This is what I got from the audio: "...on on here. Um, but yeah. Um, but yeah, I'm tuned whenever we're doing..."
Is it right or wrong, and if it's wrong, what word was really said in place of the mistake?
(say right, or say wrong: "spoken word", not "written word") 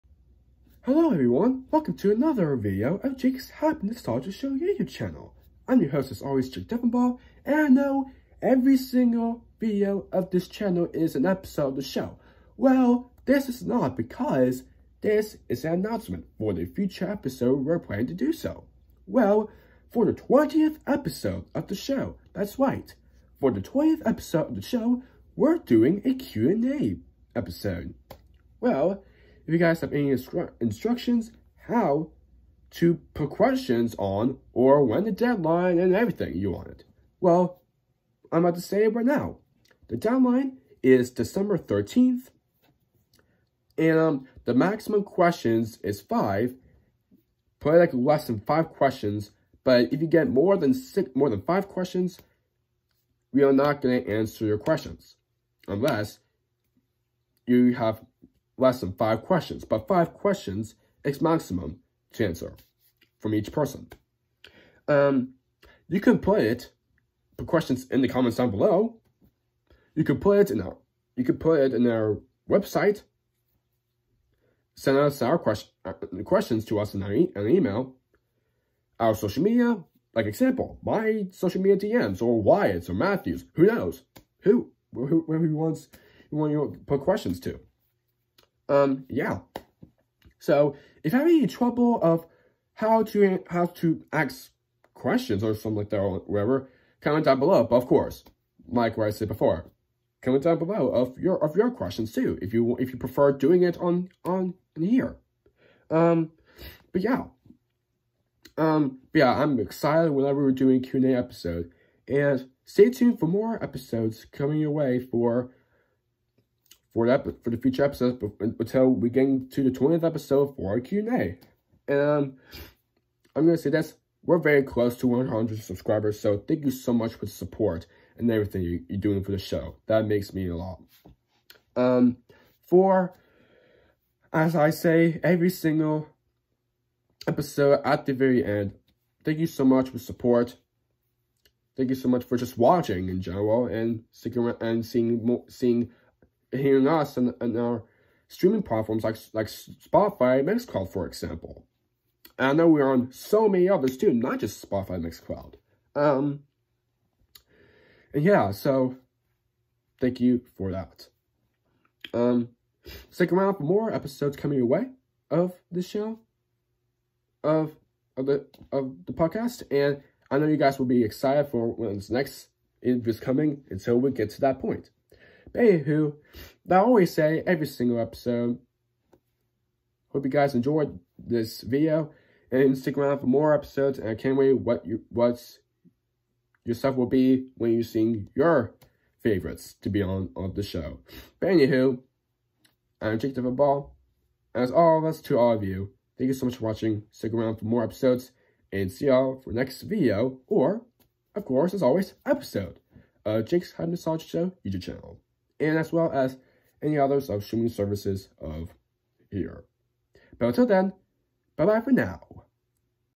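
wrong: "excited", not "tuned".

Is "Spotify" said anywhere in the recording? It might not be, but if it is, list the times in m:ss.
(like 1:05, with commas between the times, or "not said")
2:29, 2:34.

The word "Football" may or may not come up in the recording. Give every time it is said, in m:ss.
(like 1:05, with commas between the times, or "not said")
3:13.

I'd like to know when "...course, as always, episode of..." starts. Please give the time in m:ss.
3:21.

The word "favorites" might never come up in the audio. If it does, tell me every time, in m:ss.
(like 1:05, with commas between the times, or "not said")
3:09.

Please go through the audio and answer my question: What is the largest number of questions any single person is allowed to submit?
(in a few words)
5.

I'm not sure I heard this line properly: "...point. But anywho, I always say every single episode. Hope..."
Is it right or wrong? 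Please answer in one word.
right.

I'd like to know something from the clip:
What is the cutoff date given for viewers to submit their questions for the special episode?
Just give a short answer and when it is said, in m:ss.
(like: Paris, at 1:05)
December 13th, at 0:41.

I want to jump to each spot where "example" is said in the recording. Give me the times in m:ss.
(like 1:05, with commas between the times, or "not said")
1:20, 2:31.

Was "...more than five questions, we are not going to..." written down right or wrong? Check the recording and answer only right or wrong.
right.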